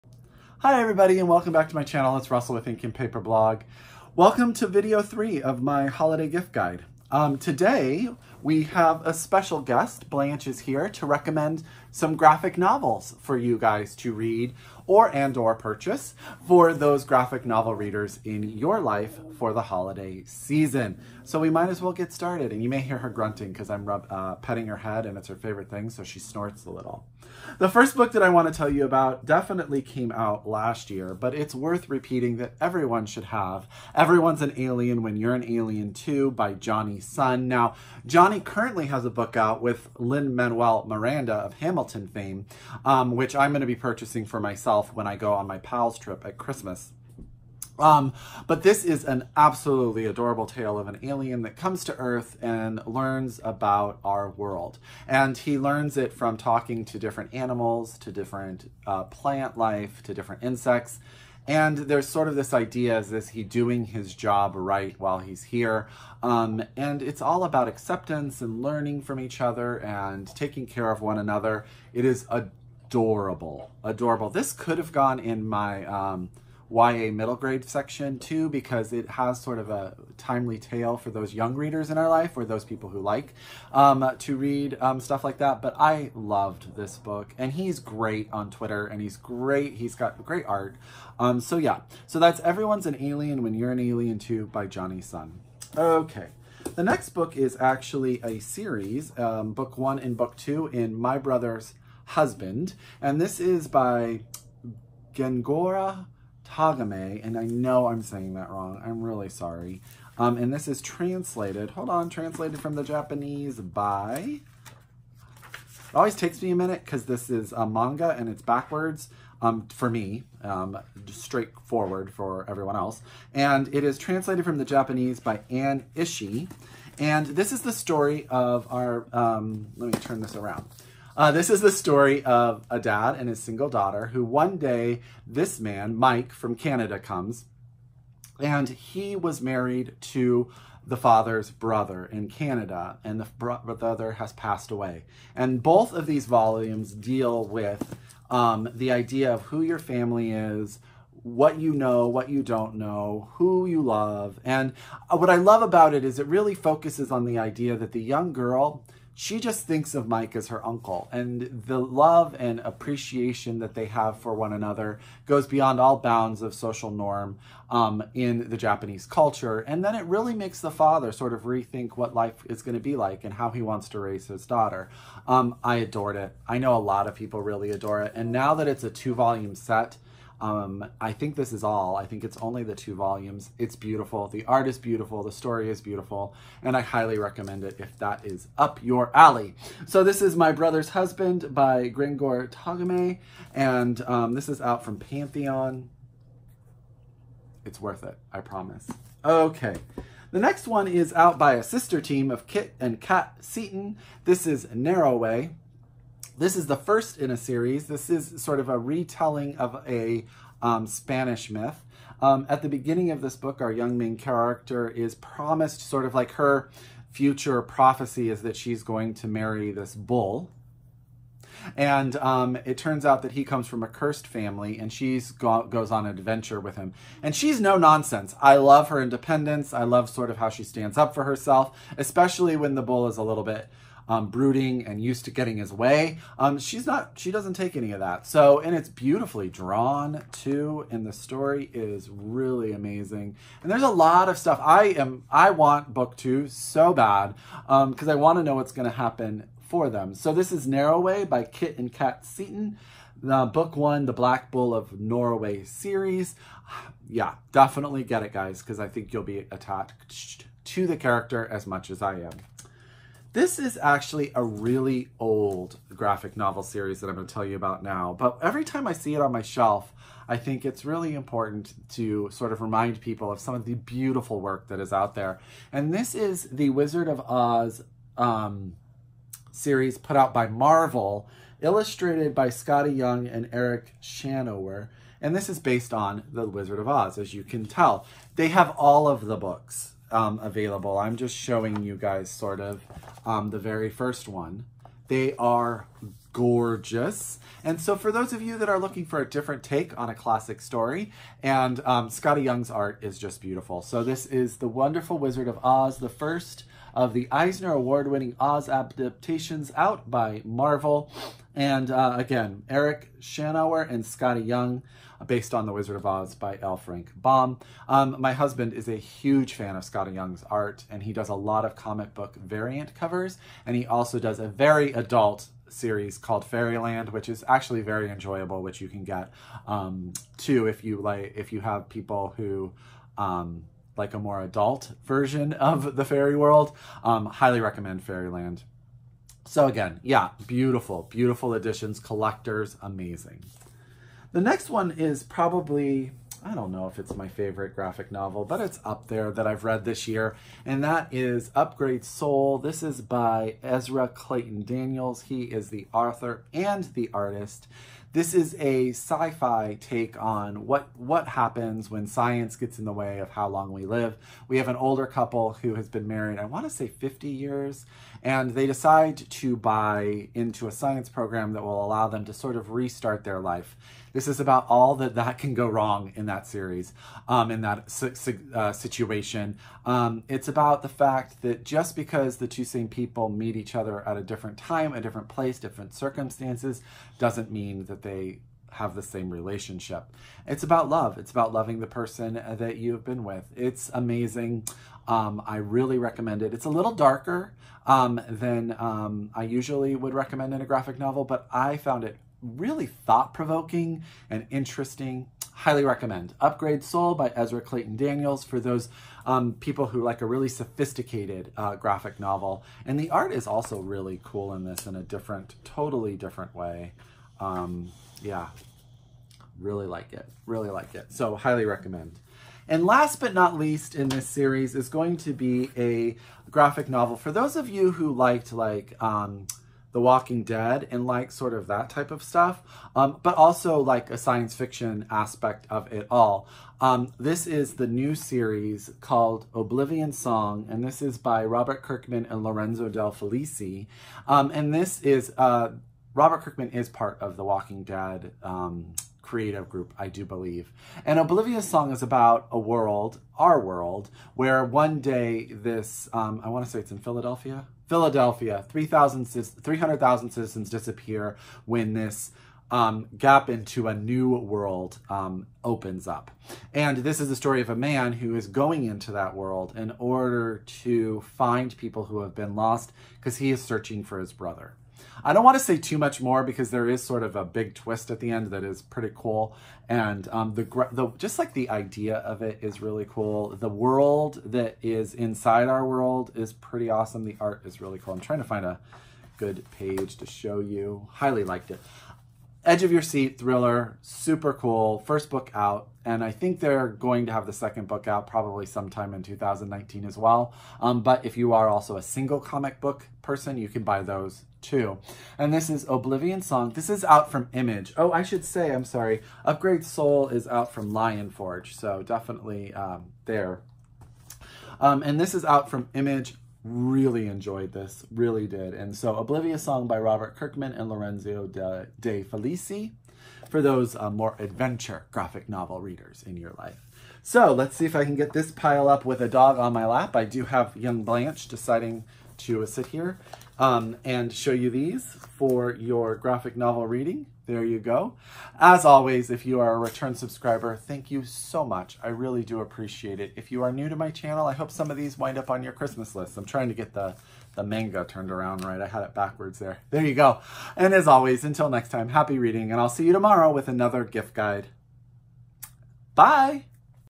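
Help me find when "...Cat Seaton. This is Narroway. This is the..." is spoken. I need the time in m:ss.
3:22.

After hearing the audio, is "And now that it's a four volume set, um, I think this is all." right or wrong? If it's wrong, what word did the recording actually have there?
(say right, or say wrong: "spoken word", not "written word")
wrong: "two", not "four".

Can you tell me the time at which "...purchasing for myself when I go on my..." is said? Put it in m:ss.
0:43.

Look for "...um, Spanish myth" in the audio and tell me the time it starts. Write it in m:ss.
3:30.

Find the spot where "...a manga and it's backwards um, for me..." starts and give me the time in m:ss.
1:57.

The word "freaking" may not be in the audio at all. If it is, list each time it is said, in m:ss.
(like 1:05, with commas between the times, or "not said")
not said.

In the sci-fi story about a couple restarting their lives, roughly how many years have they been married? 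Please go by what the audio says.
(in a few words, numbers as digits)
50 years.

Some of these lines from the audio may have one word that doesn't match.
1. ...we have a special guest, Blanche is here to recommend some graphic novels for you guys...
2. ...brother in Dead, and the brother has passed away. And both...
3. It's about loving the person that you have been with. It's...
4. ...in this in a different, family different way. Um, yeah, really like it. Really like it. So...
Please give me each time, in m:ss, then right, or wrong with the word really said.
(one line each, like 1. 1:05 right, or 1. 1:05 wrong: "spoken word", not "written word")
1. 0:08 right
2. 2:21 wrong: "Canada", not "Dead"
3. 6:31 right
4. 6:54 wrong: "totally", not "family".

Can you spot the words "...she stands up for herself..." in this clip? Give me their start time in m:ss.
3:50.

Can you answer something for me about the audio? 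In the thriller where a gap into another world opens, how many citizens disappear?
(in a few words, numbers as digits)
300,000.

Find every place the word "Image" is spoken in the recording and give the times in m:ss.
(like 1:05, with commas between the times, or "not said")
8:27, 8:35.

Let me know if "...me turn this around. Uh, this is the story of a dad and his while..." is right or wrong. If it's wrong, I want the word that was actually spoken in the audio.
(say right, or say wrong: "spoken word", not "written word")
wrong: "single", not "while".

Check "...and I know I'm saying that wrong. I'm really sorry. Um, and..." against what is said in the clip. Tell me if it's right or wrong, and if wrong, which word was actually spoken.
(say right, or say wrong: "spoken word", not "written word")
right.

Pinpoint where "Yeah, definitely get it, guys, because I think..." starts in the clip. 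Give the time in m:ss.
4:17.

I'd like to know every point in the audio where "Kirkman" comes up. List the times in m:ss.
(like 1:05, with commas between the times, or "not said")
7:21, 7:26, 8:40.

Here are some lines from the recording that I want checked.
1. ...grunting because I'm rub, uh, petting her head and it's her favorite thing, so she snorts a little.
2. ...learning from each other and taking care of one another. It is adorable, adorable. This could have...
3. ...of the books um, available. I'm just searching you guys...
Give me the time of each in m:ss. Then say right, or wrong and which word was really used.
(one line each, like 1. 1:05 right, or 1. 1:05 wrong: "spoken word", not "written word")
1. 0:23 right
2. 1:08 right
3. 4:49 wrong: "showing", not "searching".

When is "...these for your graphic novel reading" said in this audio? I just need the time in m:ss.
8:54.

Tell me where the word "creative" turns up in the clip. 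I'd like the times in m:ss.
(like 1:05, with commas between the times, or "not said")
7:29.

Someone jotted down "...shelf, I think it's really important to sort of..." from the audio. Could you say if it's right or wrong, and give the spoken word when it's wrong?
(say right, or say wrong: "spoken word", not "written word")
right.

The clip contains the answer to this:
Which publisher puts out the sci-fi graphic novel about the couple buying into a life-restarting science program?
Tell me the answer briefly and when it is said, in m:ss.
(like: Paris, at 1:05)
Lion Forge, at 8:30.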